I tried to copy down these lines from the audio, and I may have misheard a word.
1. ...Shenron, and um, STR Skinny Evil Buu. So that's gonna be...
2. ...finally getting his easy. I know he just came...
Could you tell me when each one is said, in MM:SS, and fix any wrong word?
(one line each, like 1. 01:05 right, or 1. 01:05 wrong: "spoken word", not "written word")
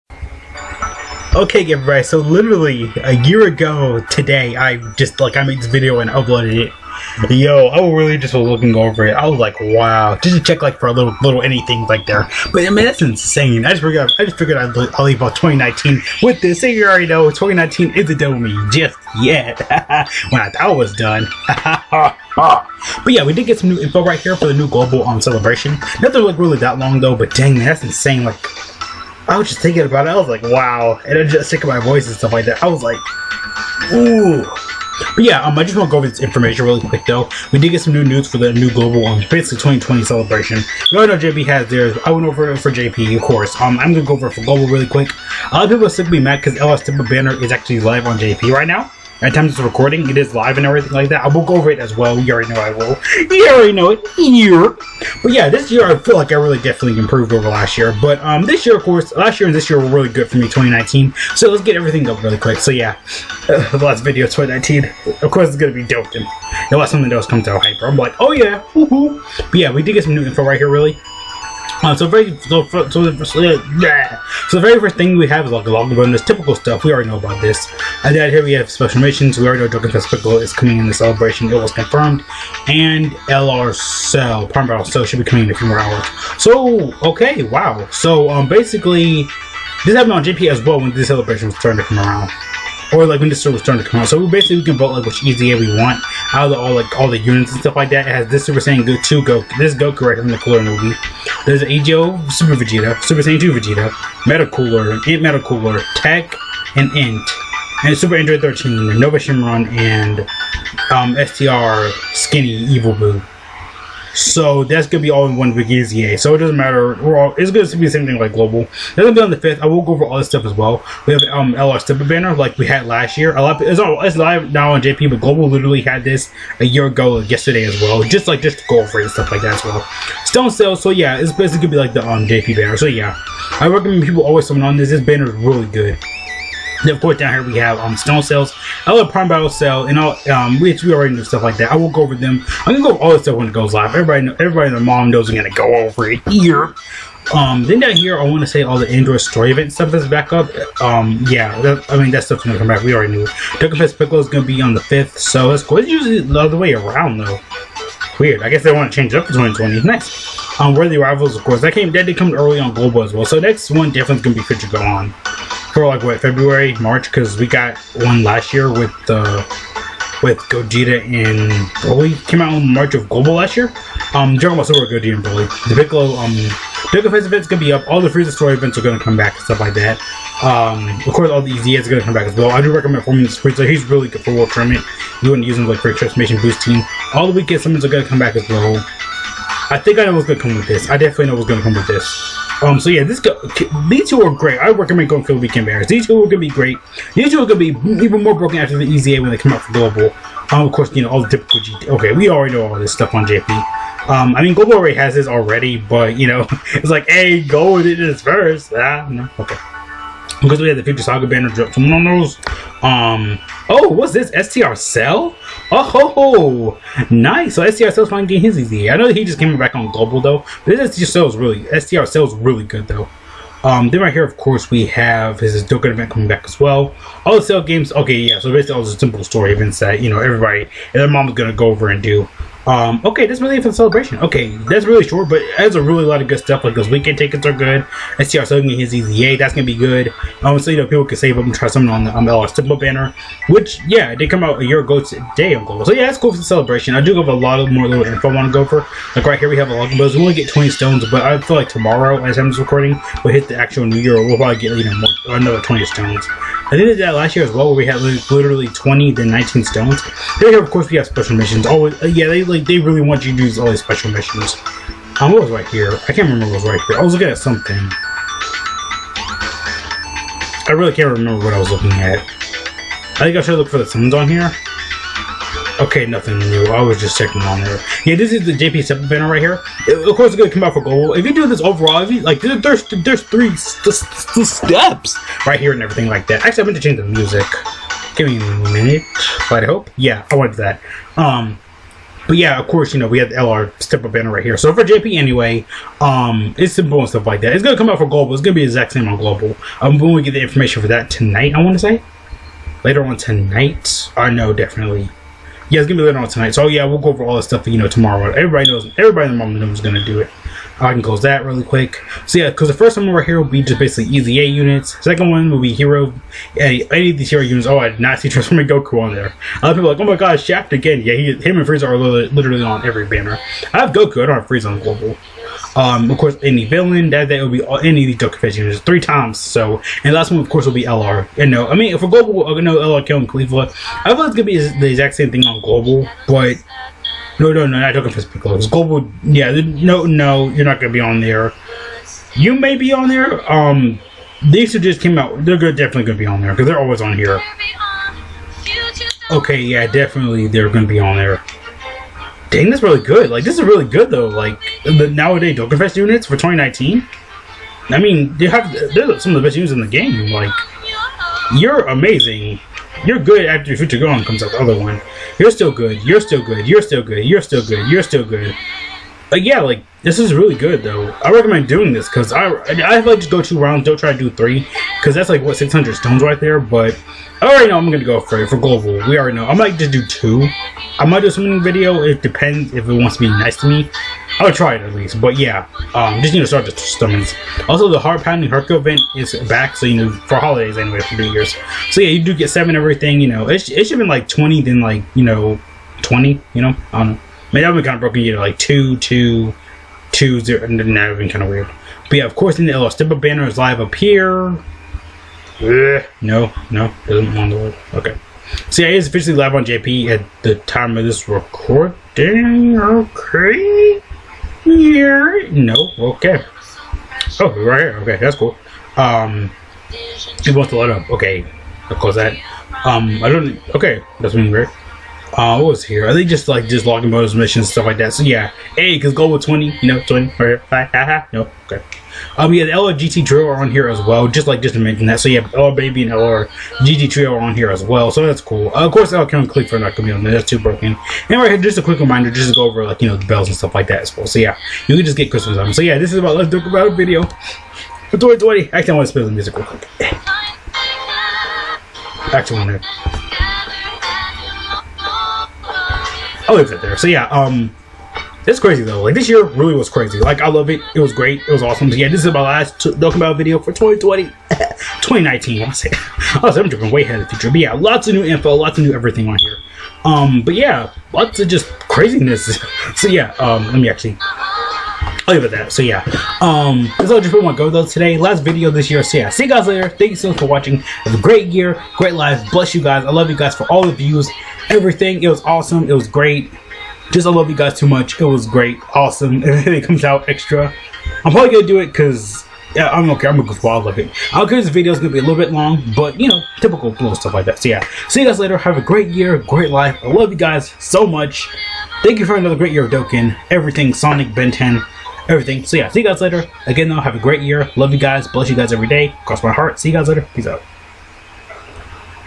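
1. 01:49 right
2. 03:38 right.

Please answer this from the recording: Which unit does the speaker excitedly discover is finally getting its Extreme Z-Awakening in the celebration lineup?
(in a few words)
STR Cell.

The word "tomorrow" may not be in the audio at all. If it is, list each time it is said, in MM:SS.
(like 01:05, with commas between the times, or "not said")
04:11, 05:07.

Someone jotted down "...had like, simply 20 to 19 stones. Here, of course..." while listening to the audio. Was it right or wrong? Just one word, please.
wrong.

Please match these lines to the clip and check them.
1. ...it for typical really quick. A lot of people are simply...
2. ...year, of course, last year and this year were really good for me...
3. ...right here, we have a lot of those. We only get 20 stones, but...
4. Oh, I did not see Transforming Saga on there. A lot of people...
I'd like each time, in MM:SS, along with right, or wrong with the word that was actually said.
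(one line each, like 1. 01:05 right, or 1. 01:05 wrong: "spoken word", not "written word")
1. 00:44 wrong: "global", not "typical"
2. 00:58 right
3. 04:09 right
4. 05:17 wrong: "Goku", not "Saga".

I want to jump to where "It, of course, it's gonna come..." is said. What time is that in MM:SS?
04:39.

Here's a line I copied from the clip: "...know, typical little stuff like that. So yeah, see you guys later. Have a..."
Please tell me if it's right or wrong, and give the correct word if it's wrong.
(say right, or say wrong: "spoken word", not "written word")
right.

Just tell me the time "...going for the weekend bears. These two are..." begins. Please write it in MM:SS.
03:15.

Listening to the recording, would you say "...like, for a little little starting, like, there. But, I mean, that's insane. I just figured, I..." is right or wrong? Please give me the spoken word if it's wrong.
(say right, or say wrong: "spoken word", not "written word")
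wrong: "anything", not "starting".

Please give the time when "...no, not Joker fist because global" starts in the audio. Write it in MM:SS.
05:37.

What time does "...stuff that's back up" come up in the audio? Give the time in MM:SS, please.
02:29.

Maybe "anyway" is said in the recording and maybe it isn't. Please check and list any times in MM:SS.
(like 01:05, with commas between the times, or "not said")
04:55, 06:30.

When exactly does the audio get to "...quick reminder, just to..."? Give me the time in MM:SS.
07:21.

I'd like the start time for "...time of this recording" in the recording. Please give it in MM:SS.
06:50.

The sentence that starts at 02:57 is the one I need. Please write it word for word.
All the Frieza story events are gonna come back and stuff like that.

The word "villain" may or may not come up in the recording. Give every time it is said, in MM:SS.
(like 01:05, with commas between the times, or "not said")
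05:26.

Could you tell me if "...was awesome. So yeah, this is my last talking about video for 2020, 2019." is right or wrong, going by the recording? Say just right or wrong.
right.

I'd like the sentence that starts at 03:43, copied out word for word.
Um, then right here, of course, we have his Dokkan event coming back as well.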